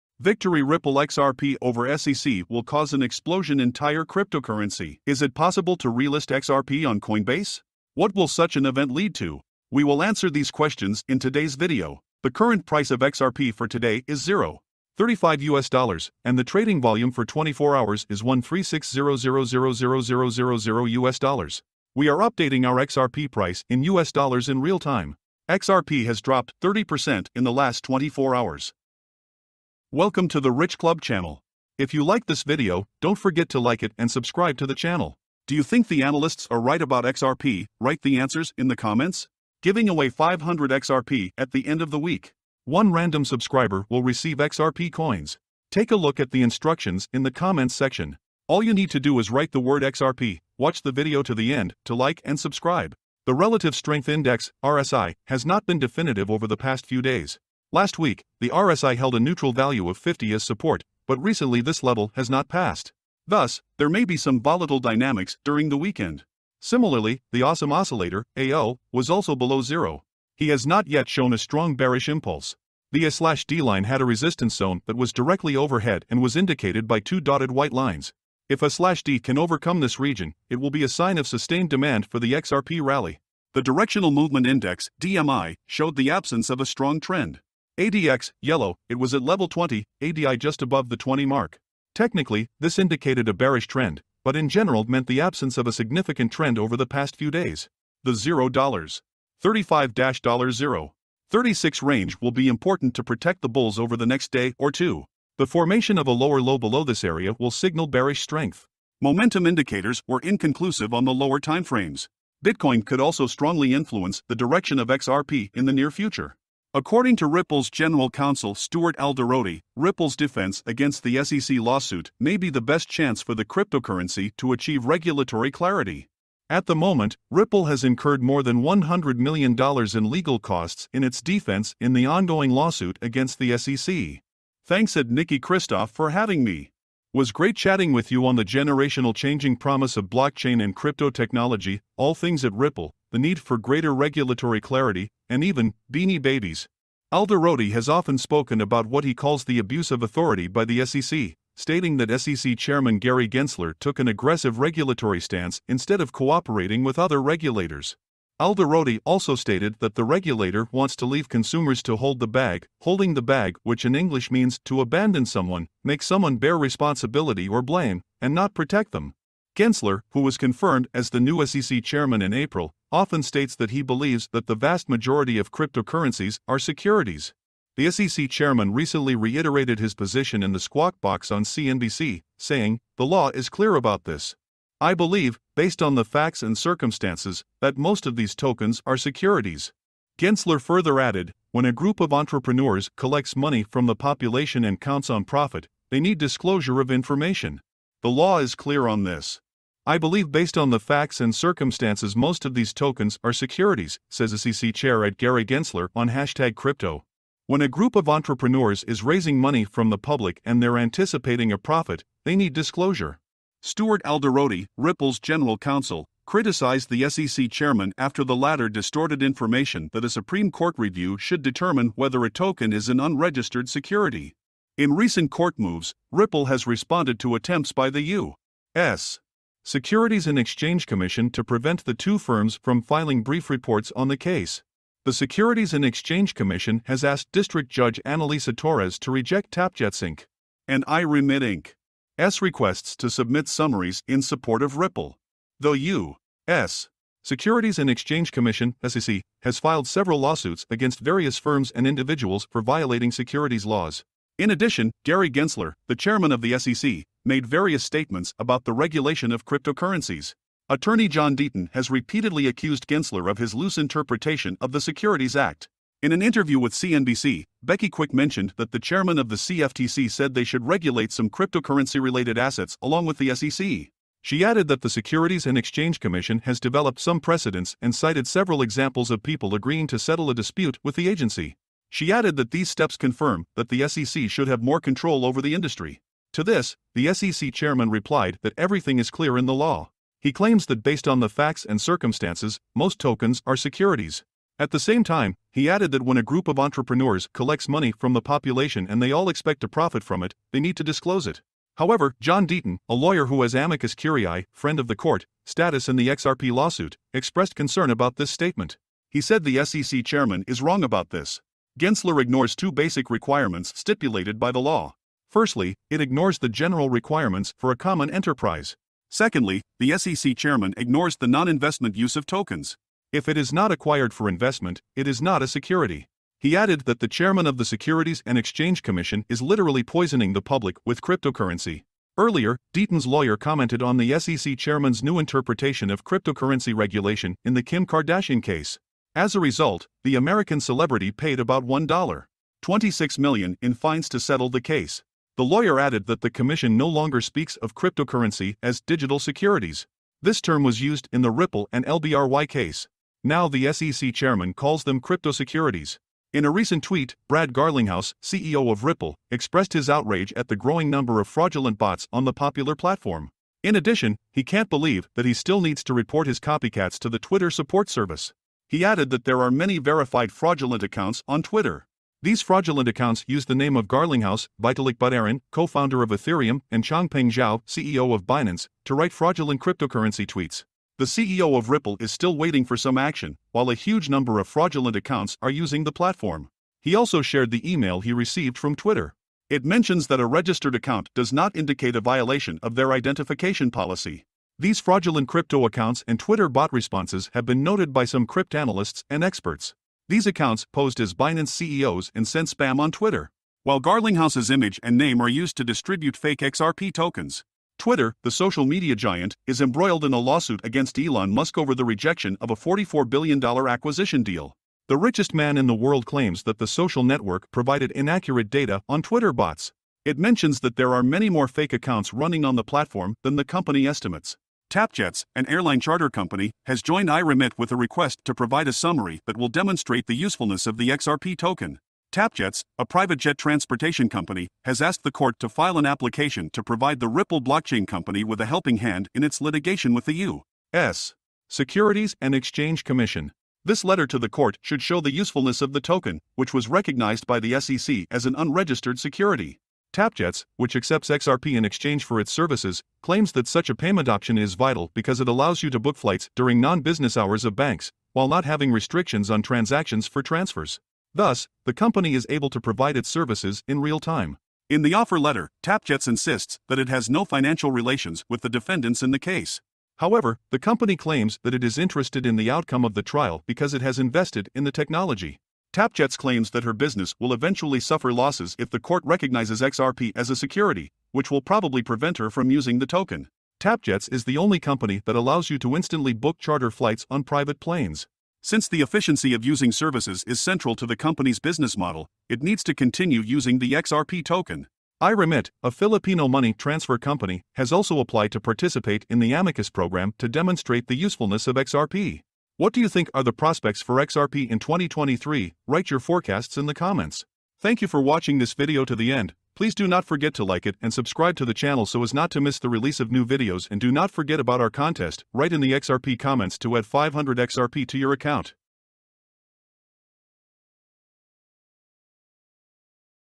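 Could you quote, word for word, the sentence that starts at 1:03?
Thus, there may be some volatile dynamics during the weekend.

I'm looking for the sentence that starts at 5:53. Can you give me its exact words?
Now the SEC chairman calls them crypto securities.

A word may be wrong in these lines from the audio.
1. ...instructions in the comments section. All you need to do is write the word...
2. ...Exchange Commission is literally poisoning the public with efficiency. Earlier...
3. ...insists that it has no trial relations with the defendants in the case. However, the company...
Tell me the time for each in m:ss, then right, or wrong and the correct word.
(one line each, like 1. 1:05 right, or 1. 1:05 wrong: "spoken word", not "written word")
1. 0:46 right
2. 5:28 wrong: "cryptocurrency", not "efficiency"
3. 7:46 wrong: "financial", not "trial".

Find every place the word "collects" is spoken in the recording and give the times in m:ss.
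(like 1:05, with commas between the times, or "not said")
3:12, 4:57.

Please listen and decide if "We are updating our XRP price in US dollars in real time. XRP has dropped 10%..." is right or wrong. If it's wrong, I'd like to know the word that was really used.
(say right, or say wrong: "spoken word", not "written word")
wrong: "30", not "10".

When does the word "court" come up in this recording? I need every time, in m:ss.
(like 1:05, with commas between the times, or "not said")
3:40, 3:45, 5:04, 7:15, 7:24, 7:58.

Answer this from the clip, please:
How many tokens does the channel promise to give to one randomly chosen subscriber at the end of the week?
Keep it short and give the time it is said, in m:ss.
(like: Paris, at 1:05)
500, at 0:39.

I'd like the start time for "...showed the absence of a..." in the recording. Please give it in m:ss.
1:25.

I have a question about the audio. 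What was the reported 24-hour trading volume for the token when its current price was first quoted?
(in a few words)
$136000000.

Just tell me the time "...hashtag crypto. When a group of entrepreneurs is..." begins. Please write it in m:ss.
3:26.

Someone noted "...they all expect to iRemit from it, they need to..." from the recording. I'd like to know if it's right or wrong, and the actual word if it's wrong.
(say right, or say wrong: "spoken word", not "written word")
wrong: "profit", not "iRemit".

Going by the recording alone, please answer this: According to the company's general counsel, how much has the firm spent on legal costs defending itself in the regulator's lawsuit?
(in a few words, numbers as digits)
more than $100 million.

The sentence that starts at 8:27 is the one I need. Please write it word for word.
Thank you for watching this video to the end.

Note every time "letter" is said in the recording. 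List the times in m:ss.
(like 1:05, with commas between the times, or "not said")
7:23, 7:45.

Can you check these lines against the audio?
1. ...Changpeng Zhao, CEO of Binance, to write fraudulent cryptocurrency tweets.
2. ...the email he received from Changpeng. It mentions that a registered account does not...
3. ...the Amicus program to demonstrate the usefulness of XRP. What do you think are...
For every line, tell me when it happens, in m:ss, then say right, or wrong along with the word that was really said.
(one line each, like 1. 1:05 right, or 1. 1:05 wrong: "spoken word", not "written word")
1. 6:16 right
2. 6:27 wrong: "Twitter", not "Changpeng"
3. 8:19 right.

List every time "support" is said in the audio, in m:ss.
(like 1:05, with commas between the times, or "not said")
1:00, 4:04, 6:07.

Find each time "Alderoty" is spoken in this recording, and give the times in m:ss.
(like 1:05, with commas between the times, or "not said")
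1:58, 2:27, 2:38, 3:34.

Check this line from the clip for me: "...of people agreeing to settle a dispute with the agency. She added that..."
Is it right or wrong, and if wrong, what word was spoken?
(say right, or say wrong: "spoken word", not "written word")
right.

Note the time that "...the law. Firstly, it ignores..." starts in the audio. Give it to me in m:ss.
5:14.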